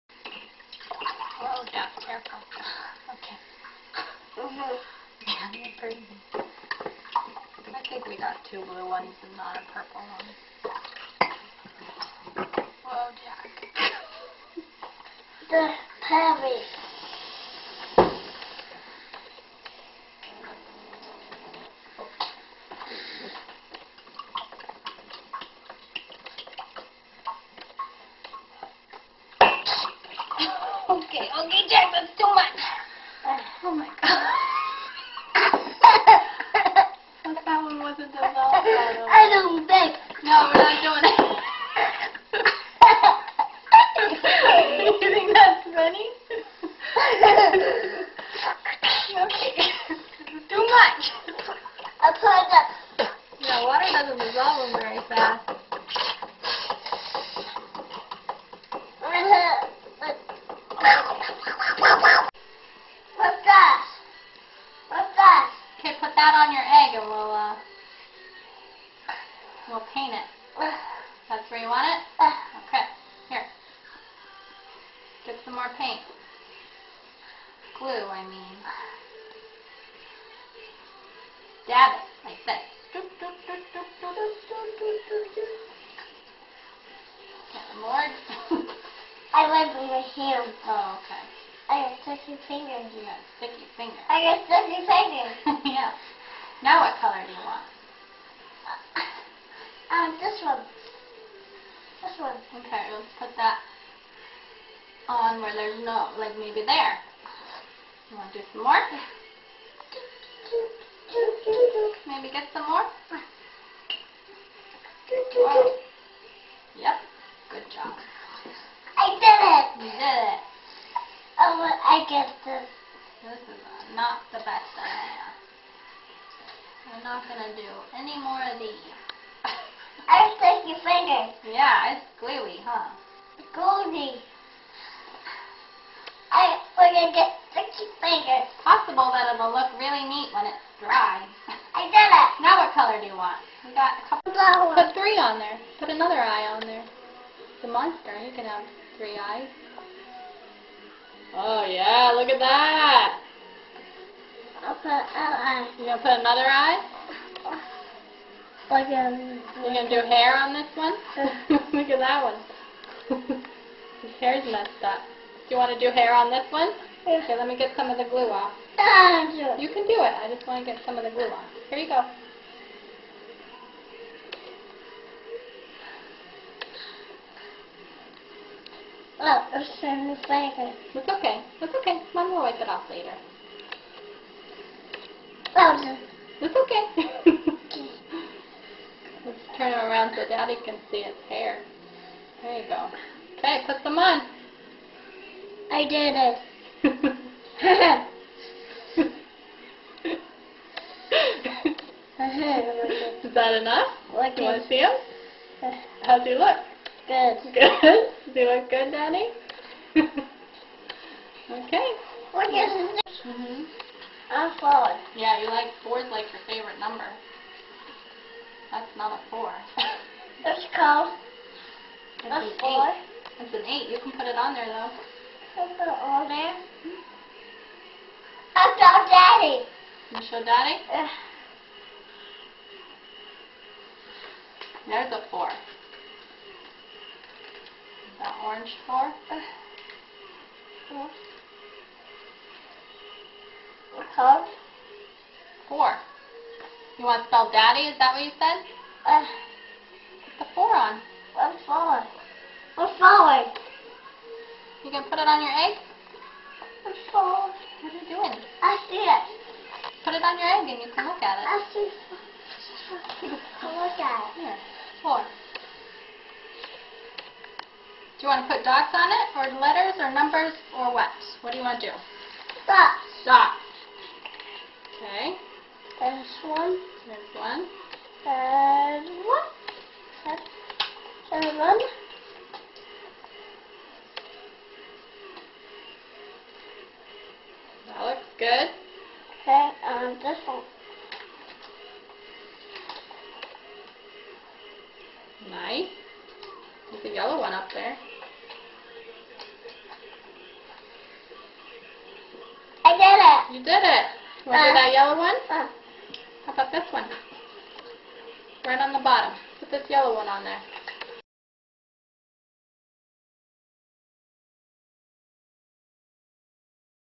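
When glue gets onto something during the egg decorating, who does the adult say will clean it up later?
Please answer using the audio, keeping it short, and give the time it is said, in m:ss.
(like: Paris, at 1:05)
Mom, at 3:02.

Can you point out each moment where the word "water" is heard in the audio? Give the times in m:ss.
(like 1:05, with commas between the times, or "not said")
0:53.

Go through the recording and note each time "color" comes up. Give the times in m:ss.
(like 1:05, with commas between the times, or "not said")
1:37, 2:22.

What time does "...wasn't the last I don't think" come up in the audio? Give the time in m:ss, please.
0:37.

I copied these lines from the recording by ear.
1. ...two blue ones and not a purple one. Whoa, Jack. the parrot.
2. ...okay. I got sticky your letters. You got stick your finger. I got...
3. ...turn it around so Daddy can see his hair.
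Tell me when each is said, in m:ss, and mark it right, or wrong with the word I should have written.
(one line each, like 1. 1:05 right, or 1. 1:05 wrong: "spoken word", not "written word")
1. 0:08 right
2. 1:31 wrong: "fingers", not "letters"
3. 3:09 right.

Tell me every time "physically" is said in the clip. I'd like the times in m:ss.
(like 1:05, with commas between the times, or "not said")
not said.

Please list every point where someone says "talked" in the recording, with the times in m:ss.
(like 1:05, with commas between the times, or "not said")
not said.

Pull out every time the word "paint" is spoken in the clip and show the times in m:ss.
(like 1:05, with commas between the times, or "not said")
1:09, 1:15.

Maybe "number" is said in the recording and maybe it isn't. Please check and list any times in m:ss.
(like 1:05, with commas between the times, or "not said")
3:36, 4:30.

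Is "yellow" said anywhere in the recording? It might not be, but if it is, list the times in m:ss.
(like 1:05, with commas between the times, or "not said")
4:57, 5:04, 5:09.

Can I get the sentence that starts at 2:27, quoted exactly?
The monster, You can have three eyes.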